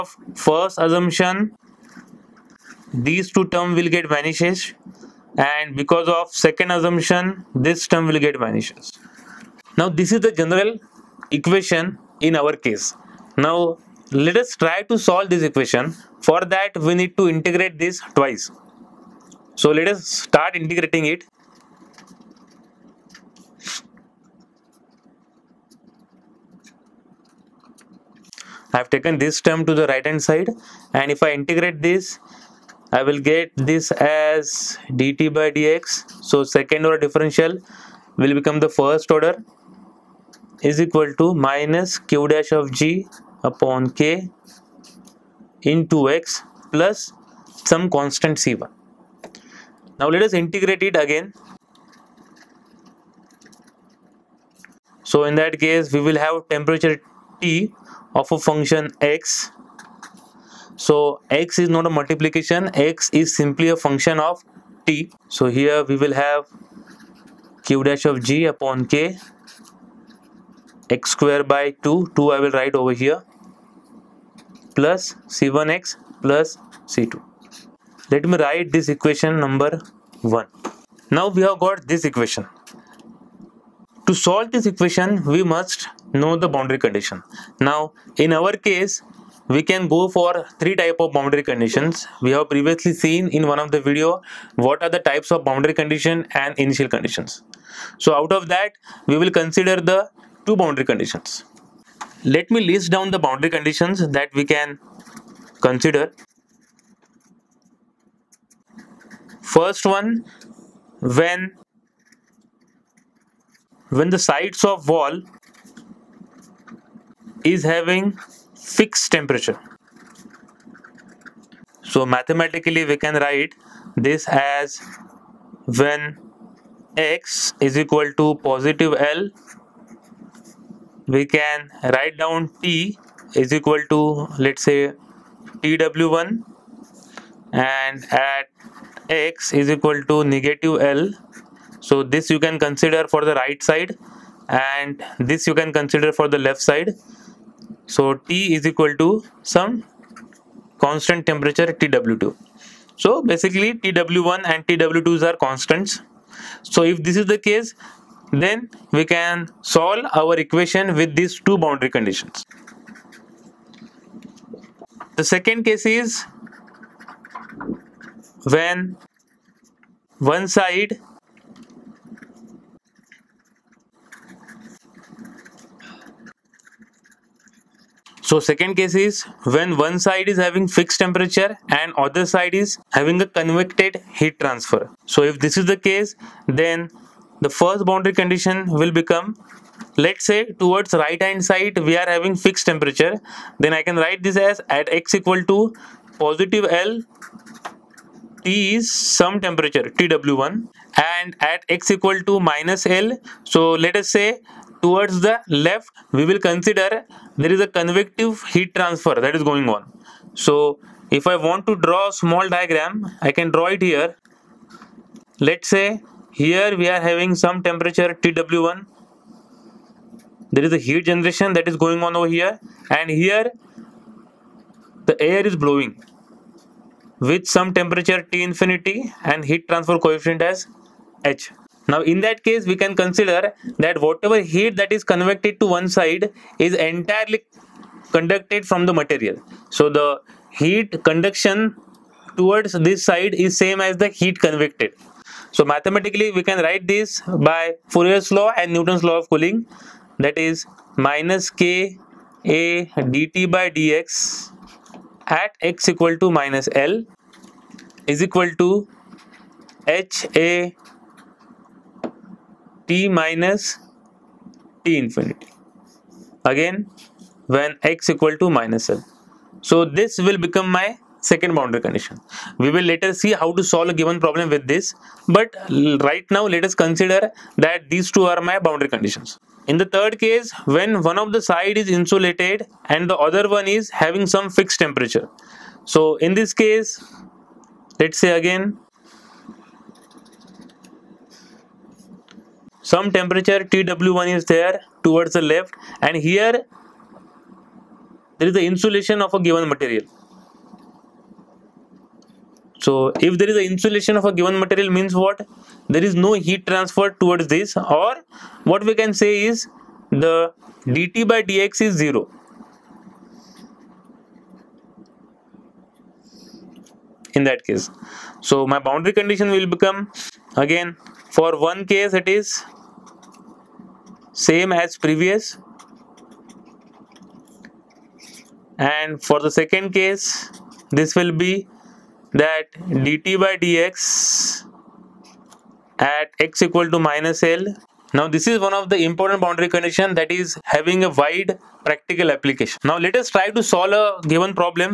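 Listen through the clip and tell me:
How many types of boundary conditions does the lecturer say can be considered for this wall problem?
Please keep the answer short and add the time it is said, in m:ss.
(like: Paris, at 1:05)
3, at 1:30.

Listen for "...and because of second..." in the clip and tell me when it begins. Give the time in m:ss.
0:05.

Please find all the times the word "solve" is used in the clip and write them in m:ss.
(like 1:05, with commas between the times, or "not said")
0:14, 1:24, 2:39, 4:33, 5:43.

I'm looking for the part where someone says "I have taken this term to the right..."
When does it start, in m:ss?
0:28.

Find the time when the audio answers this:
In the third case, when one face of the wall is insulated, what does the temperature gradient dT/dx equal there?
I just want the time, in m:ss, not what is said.
5:11.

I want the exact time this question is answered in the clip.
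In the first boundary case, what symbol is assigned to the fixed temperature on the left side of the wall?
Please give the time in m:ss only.
2:31.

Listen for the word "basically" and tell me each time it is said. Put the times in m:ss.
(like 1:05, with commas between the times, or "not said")
2:33.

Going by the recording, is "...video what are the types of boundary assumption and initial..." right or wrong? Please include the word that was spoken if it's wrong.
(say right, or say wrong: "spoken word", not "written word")
wrong: "condition", not "assumption".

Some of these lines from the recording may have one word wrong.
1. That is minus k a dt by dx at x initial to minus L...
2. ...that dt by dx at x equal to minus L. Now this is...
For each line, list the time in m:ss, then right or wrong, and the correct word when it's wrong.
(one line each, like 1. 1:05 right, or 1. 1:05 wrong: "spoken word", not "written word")
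1. 4:10 wrong: "equal", not "initial"
2. 5:32 right.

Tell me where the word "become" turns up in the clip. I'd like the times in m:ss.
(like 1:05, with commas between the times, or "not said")
0:38, 3:08, 4:30, 5:19.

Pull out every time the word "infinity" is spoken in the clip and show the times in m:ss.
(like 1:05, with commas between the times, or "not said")
3:48, 4:24.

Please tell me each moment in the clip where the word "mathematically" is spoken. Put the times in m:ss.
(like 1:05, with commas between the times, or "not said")
2:02, 4:05.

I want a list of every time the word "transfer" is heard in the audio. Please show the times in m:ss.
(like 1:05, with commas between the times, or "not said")
3:04, 3:28, 3:49, 5:06.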